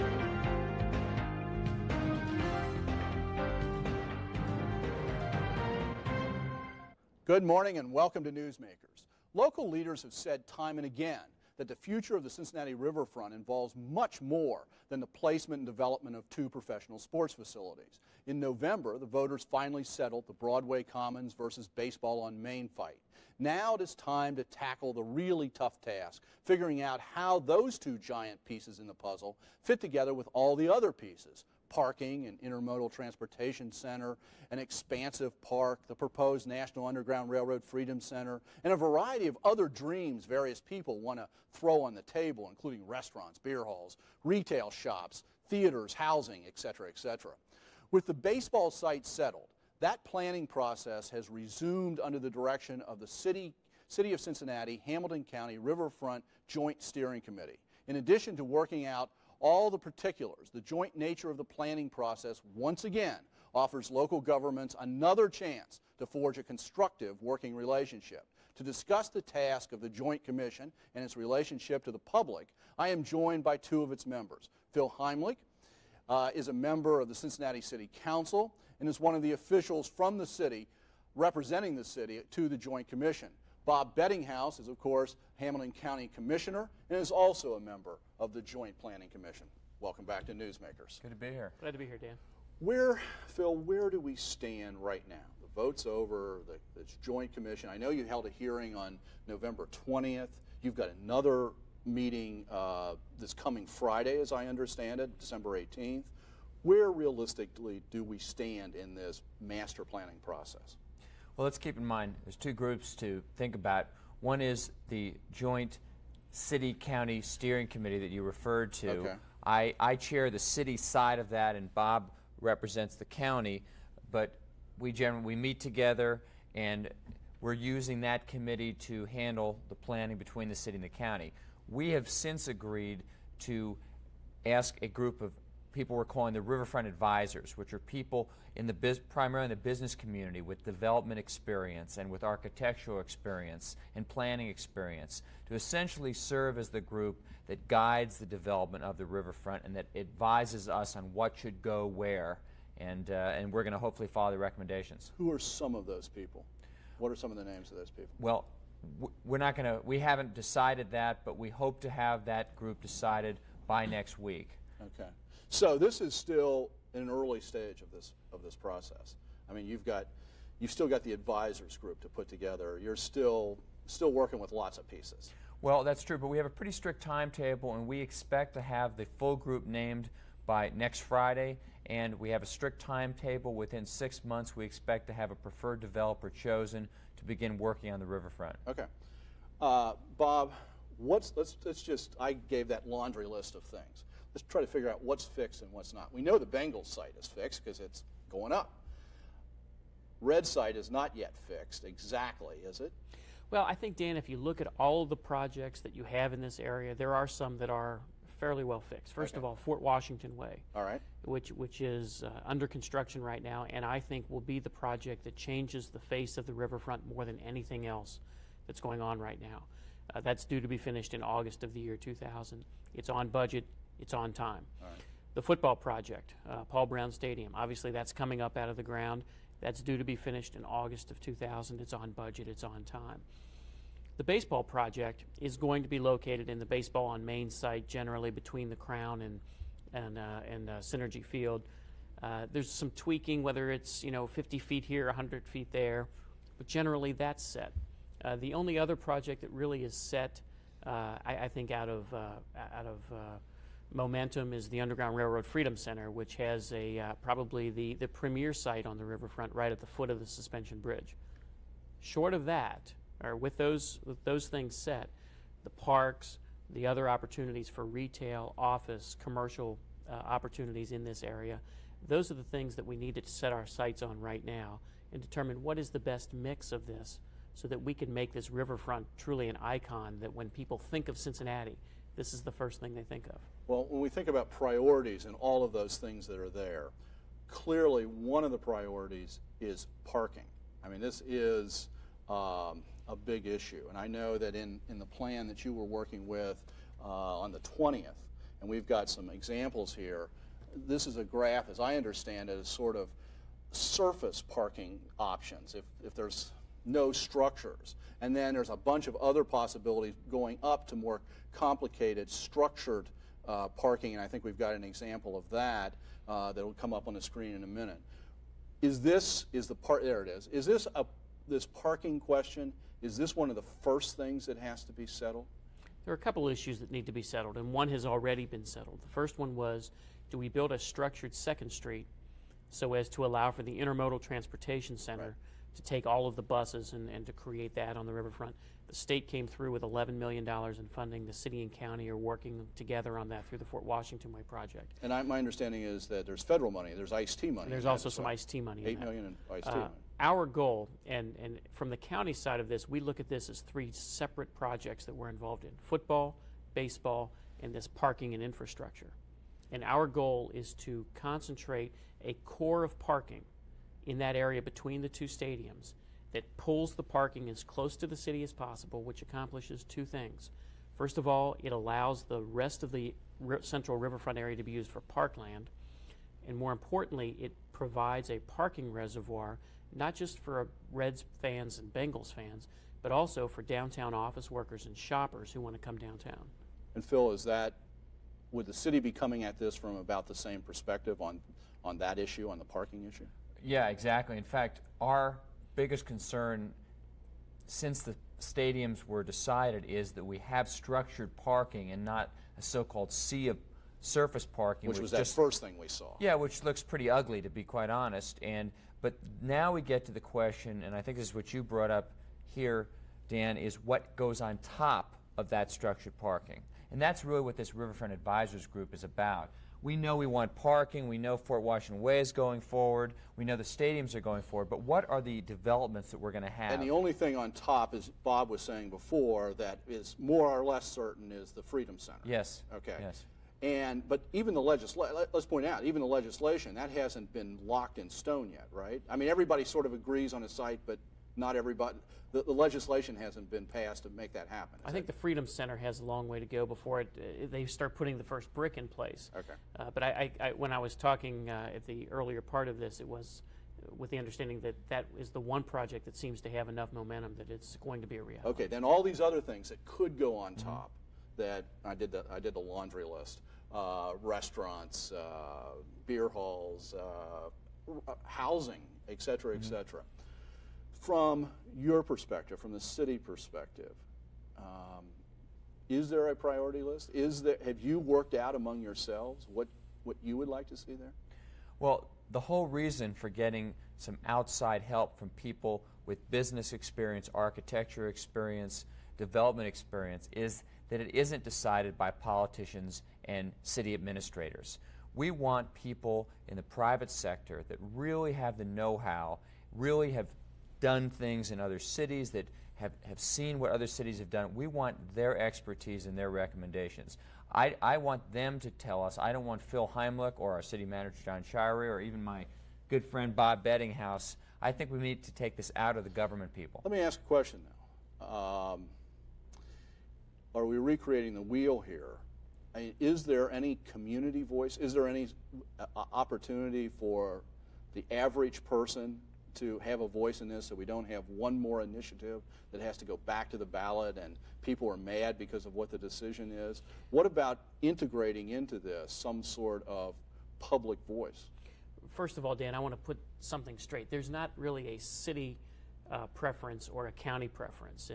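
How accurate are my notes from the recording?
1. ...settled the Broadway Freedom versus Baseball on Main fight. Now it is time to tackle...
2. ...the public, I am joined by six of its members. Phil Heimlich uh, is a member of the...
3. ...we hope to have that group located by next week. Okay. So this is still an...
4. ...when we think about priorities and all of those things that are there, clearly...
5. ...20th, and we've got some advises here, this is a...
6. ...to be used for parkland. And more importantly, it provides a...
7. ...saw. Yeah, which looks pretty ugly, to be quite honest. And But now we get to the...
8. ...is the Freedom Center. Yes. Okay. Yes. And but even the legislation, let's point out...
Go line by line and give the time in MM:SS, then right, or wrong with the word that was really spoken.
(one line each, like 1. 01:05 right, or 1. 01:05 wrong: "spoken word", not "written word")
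1. 00:19 wrong: "Commons", not "Freedom"
2. 01:11 wrong: "two", not "six"
3. 02:41 wrong: "decided", not "located"
4. 04:43 right
5. 04:57 wrong: "examples", not "advises"
6. 06:14 right
7. 06:45 right
8. 07:11 right.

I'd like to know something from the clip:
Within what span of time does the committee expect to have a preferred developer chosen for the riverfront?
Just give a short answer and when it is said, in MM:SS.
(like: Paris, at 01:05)
six months, at 03:03.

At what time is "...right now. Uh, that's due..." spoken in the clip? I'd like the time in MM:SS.
03:39.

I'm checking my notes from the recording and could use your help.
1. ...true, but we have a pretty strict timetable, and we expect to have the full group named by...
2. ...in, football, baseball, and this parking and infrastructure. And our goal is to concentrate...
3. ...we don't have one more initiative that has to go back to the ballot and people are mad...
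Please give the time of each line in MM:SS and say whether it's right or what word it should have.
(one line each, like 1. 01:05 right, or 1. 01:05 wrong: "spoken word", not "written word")
1. 02:56 right
2. 05:55 right
3. 08:50 right.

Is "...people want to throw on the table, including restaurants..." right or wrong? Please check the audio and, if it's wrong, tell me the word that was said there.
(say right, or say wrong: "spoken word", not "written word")
right.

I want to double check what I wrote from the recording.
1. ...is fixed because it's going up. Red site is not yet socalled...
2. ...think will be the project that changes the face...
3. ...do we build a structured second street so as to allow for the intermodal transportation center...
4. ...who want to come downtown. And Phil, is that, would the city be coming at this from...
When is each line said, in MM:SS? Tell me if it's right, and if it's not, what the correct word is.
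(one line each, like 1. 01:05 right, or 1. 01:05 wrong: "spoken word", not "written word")
1. 03:17 wrong: "fixed", not "socalled"
2. 03:33 right
3. 05:30 right
4. 06:25 right.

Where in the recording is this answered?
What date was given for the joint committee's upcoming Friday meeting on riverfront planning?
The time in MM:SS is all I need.
01:45.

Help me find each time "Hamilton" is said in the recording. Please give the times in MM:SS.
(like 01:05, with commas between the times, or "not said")
00:54, 01:25.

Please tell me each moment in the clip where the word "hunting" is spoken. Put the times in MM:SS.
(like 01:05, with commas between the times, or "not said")
not said.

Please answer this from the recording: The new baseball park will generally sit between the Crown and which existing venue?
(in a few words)
Cinergy Field.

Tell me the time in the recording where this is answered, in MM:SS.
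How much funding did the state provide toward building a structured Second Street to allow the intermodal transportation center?
05:39.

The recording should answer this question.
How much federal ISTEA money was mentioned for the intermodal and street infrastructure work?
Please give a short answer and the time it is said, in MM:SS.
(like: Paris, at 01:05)
8 million, at 05:48.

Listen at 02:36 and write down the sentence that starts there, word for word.
What are some of the names of those people?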